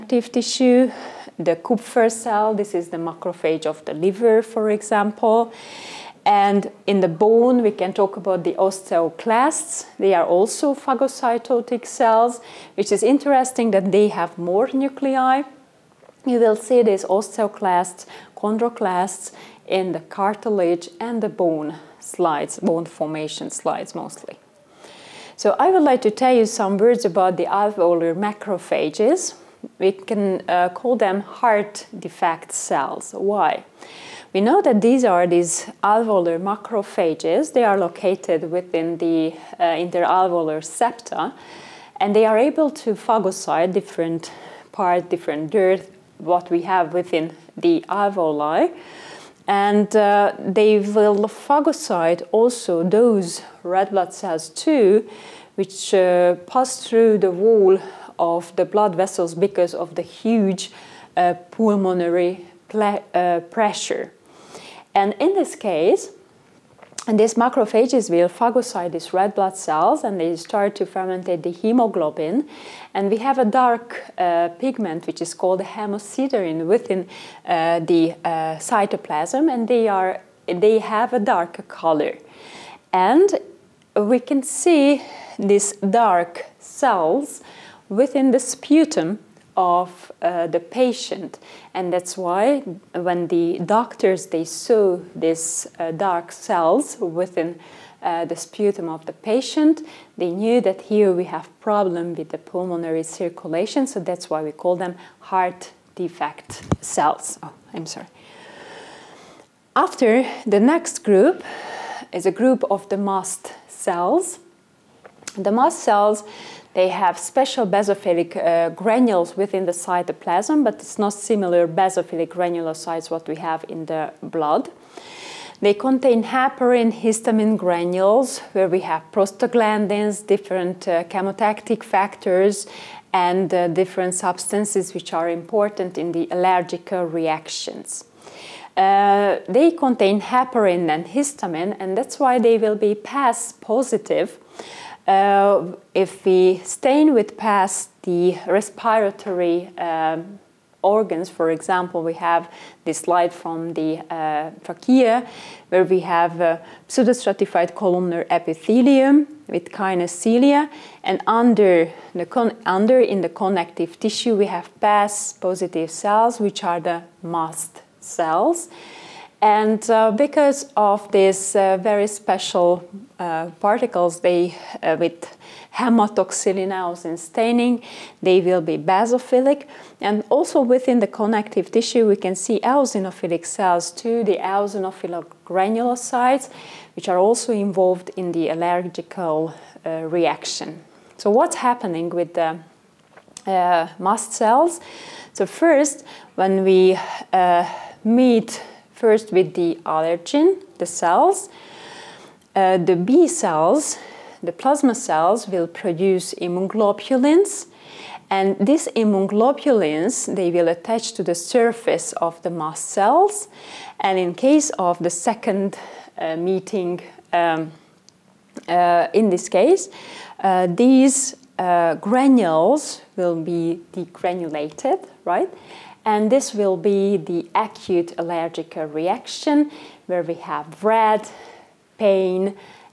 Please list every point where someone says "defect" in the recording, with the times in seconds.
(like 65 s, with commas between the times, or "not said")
31 s, 105 s.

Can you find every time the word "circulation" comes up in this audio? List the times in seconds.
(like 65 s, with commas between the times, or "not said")
103 s.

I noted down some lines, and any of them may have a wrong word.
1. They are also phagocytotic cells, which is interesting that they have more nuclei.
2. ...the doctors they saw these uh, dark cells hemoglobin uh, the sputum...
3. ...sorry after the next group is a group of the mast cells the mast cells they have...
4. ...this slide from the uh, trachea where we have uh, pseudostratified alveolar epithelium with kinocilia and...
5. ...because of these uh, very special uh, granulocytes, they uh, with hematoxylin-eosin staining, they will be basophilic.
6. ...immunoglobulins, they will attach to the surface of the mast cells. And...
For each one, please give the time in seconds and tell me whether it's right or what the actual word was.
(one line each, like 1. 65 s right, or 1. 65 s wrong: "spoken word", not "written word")
1. 9 s right
2. 93 s wrong: "within", not "hemoglobin"
3. 107 s right
4. 152 s wrong: "columnar", not "alveolar"
5. 170 s wrong: "particles", not "granulocytes"
6. 208 s right.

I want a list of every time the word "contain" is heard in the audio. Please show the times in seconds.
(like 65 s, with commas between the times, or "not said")
125 s, 139 s.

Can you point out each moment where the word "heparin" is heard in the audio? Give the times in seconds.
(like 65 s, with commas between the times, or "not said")
126 s, 140 s.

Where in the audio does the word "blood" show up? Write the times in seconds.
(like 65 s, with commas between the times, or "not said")
53 s, 58 s, 69 s, 124 s.